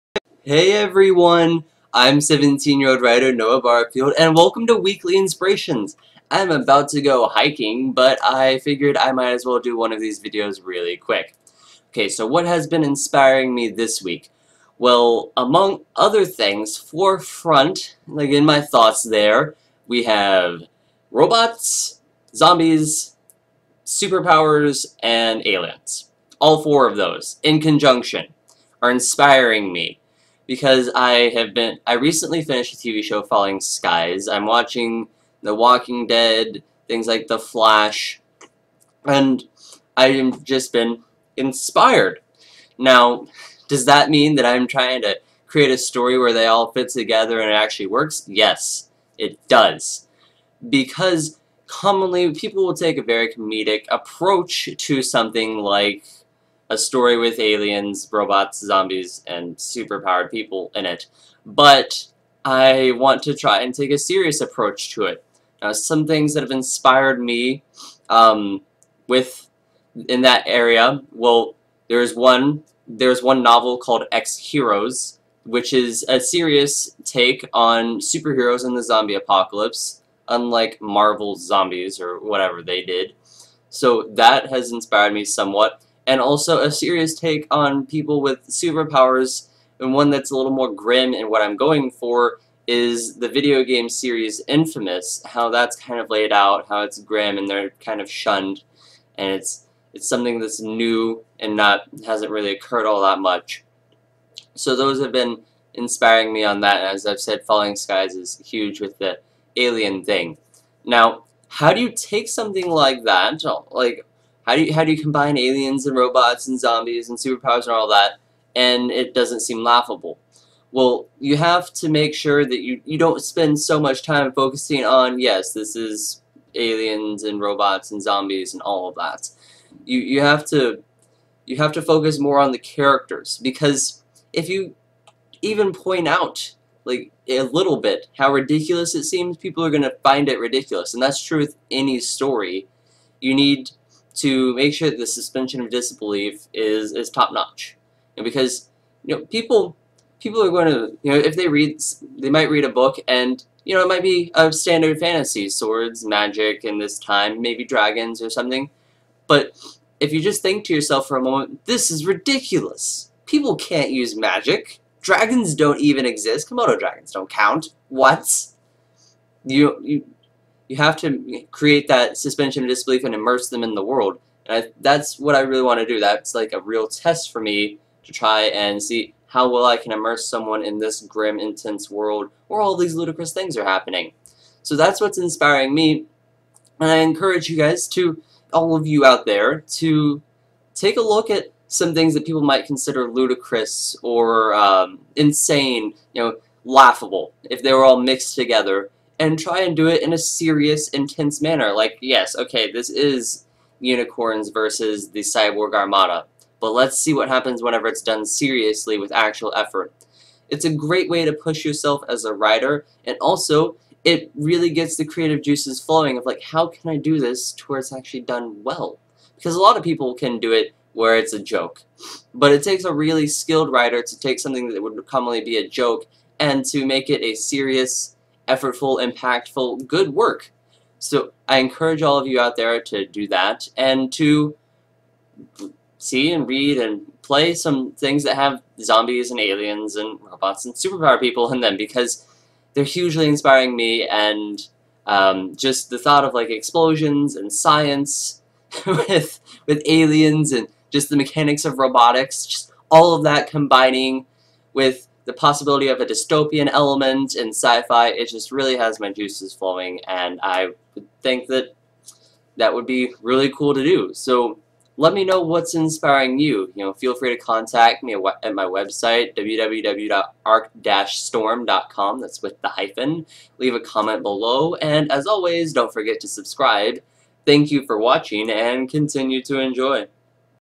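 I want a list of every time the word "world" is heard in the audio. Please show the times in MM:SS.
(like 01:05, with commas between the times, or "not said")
02:53, 03:01.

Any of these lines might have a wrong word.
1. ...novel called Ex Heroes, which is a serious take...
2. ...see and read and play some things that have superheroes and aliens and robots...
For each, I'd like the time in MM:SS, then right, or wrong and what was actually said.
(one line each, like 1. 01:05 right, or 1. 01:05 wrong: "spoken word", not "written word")
1. 01:13 right
2. 03:55 wrong: "zombies", not "superheroes".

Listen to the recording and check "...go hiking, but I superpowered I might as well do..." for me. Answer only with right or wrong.
wrong.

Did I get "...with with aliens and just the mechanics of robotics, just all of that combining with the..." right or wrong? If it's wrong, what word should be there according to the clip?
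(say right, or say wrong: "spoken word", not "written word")
right.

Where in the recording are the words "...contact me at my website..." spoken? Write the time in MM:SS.
04:27.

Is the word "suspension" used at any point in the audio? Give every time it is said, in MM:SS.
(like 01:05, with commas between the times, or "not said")
02:25, 02:52.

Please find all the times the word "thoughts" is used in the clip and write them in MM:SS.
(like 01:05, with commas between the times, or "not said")
00:18, 04:05.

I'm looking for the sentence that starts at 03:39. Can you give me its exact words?
Because a lot of people can do it where it's a joke.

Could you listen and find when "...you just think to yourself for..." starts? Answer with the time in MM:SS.
02:40.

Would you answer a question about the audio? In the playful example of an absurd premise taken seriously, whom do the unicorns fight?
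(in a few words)
the Cyborg Armada.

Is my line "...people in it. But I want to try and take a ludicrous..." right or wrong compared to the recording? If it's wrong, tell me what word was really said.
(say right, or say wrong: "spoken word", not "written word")
wrong: "serious", not "ludicrous".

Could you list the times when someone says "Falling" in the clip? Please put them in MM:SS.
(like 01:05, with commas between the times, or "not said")
00:33, 01:47.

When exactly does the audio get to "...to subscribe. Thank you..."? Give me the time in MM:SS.
04:36.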